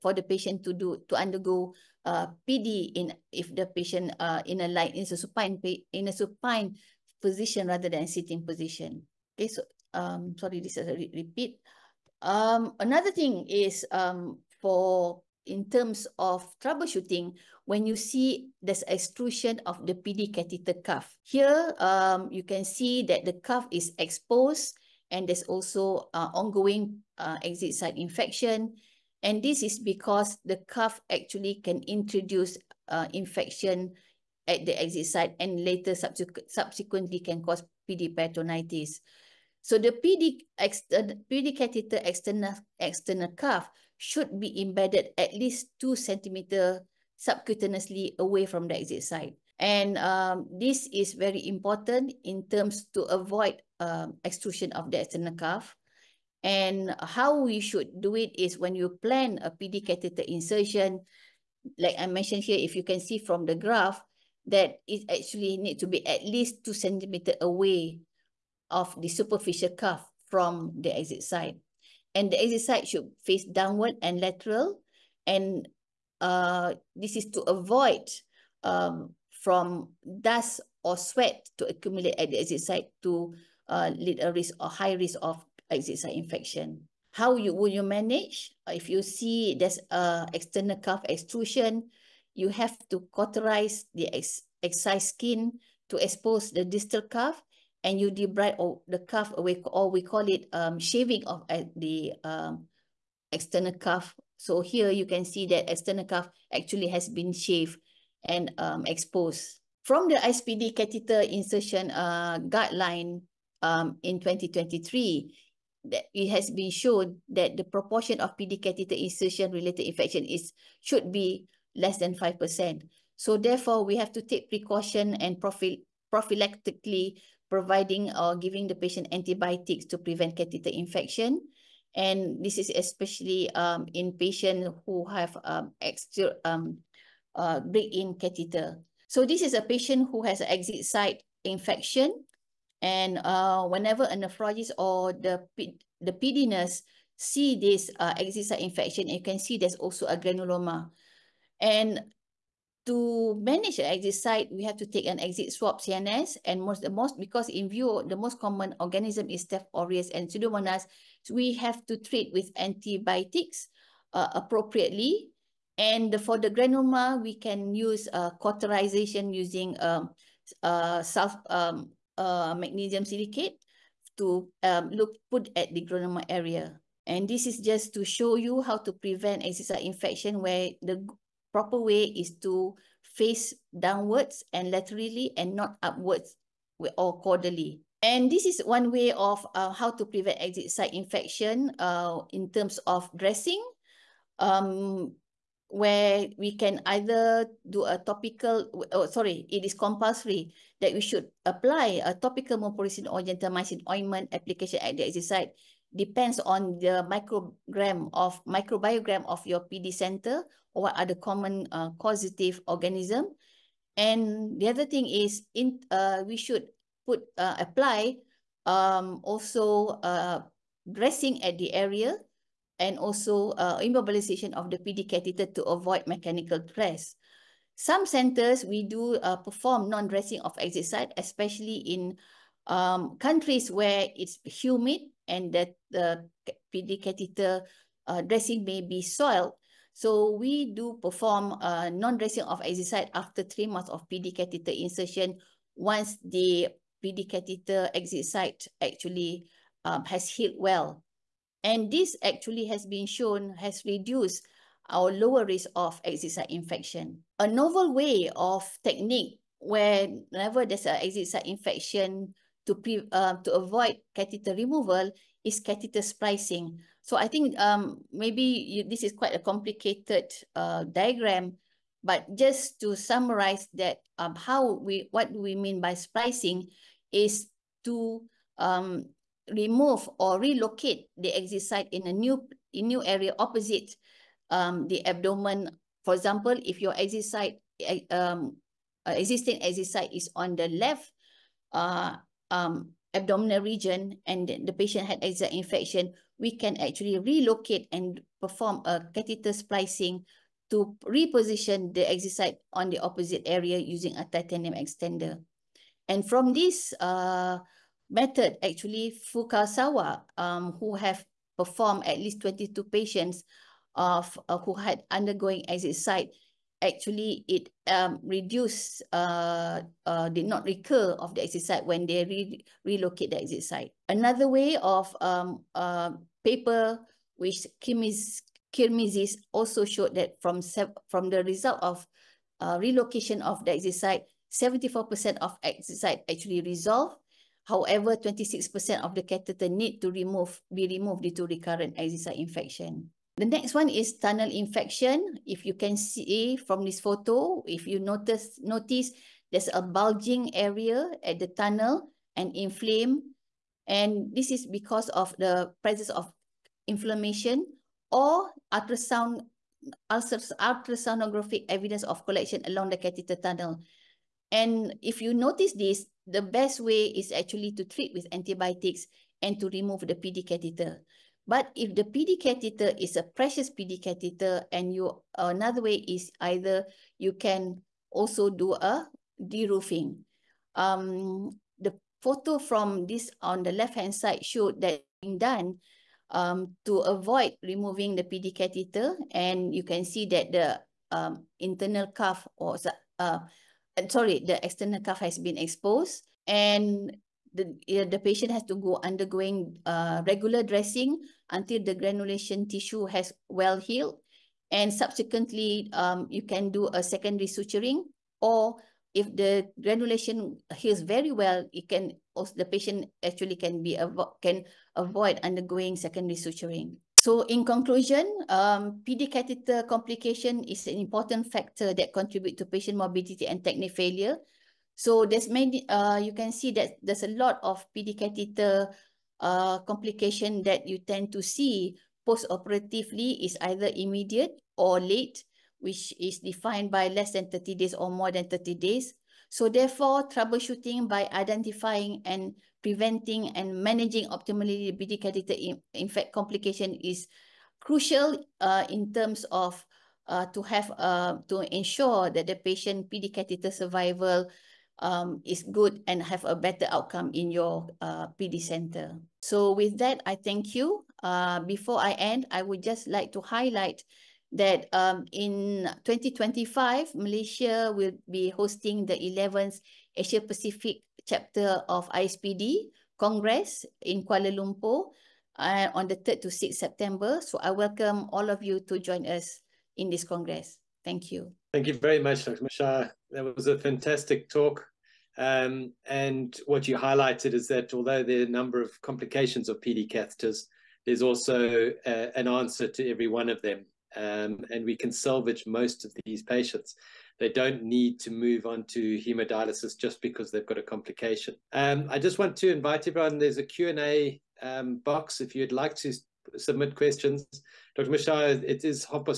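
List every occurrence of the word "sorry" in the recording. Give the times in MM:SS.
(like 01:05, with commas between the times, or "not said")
00:10, 03:19, 06:34.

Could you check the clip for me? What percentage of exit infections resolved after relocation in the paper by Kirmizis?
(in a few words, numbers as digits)
74%.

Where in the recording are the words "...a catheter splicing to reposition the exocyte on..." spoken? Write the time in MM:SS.
04:58.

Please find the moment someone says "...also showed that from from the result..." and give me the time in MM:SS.
05:29.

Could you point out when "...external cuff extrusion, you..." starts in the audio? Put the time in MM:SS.
01:30.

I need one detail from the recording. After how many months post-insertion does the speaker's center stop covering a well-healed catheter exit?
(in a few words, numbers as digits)
3 months.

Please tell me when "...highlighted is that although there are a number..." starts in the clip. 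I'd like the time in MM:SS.
08:06.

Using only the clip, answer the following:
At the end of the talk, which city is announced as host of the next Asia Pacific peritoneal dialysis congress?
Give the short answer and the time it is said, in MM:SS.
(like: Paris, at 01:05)
Kuala Lumpur, at 07:54.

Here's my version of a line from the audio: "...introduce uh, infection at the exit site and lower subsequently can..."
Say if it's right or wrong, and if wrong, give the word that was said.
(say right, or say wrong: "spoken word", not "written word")
wrong: "later", not "lower".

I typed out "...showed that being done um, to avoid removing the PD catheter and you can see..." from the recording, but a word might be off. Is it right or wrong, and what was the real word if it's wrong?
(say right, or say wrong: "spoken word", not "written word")
right.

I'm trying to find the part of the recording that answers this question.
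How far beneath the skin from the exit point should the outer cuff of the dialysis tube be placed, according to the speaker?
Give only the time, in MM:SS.
00:45.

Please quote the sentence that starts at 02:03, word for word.
So therefore, we have to take precaution and prophy prophylactically providing or giving the patient antibiotics to prevent catheter infection.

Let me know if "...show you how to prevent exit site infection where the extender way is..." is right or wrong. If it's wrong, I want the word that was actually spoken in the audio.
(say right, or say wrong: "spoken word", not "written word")
wrong: "proper", not "extender".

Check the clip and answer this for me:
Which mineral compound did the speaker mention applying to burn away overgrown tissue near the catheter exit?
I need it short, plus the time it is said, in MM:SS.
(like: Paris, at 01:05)
magnesium silicate, at 02:52.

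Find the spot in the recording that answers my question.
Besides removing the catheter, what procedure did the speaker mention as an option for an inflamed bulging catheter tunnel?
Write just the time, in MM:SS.
06:19.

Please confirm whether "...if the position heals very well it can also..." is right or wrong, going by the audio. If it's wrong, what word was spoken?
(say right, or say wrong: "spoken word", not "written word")
wrong: "granulation", not "position".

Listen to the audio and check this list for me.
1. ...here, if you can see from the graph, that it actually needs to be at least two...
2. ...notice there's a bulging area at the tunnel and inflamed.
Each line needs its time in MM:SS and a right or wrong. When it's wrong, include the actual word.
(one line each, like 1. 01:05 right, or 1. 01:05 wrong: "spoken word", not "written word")
1. 01:02 right
2. 05:48 right.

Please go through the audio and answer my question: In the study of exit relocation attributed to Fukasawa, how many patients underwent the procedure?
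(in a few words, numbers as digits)
22.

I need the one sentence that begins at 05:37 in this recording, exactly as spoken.
However, 26% of the catheter need to remove be removed due to recurrent exit site infection.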